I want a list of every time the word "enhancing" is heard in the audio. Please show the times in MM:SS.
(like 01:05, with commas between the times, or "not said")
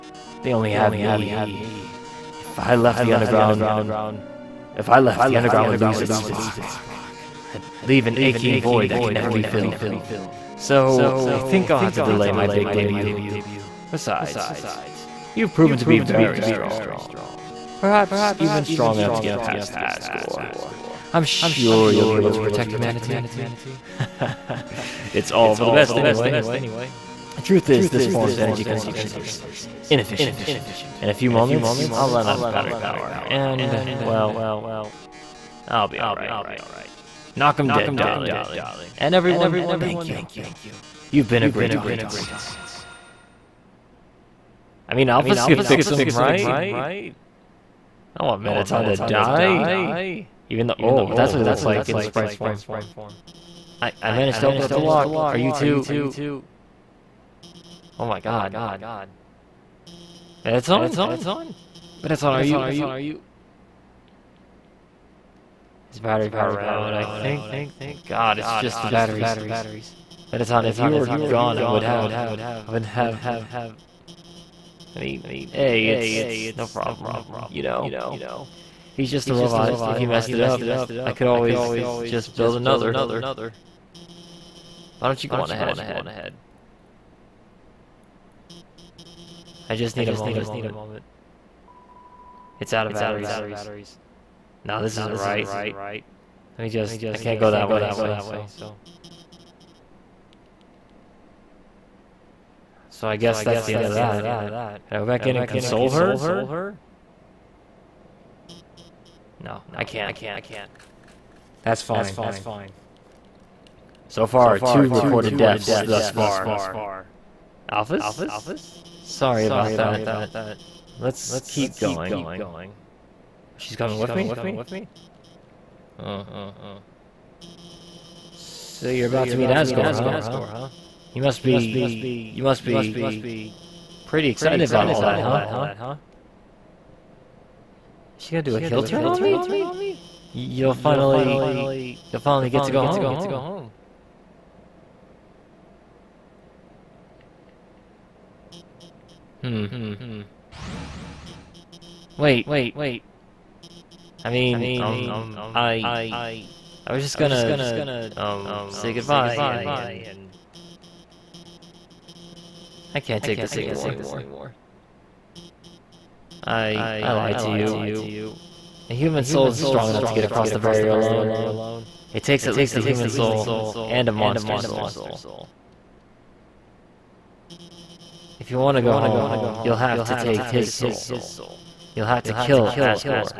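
not said.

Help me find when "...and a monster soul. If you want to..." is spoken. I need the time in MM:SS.
02:53.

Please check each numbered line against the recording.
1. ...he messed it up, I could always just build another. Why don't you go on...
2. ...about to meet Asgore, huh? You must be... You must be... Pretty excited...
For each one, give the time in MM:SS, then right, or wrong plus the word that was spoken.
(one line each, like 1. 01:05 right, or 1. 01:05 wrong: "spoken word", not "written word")
1. 01:19 right
2. 02:09 right.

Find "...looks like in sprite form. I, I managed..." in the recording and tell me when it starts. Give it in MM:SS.
00:51.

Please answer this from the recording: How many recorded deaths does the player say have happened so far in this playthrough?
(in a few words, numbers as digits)
2.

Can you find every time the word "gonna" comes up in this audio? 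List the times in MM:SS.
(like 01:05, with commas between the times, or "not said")
02:18, 02:37.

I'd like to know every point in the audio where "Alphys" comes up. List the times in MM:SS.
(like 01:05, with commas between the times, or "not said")
00:45, 01:57.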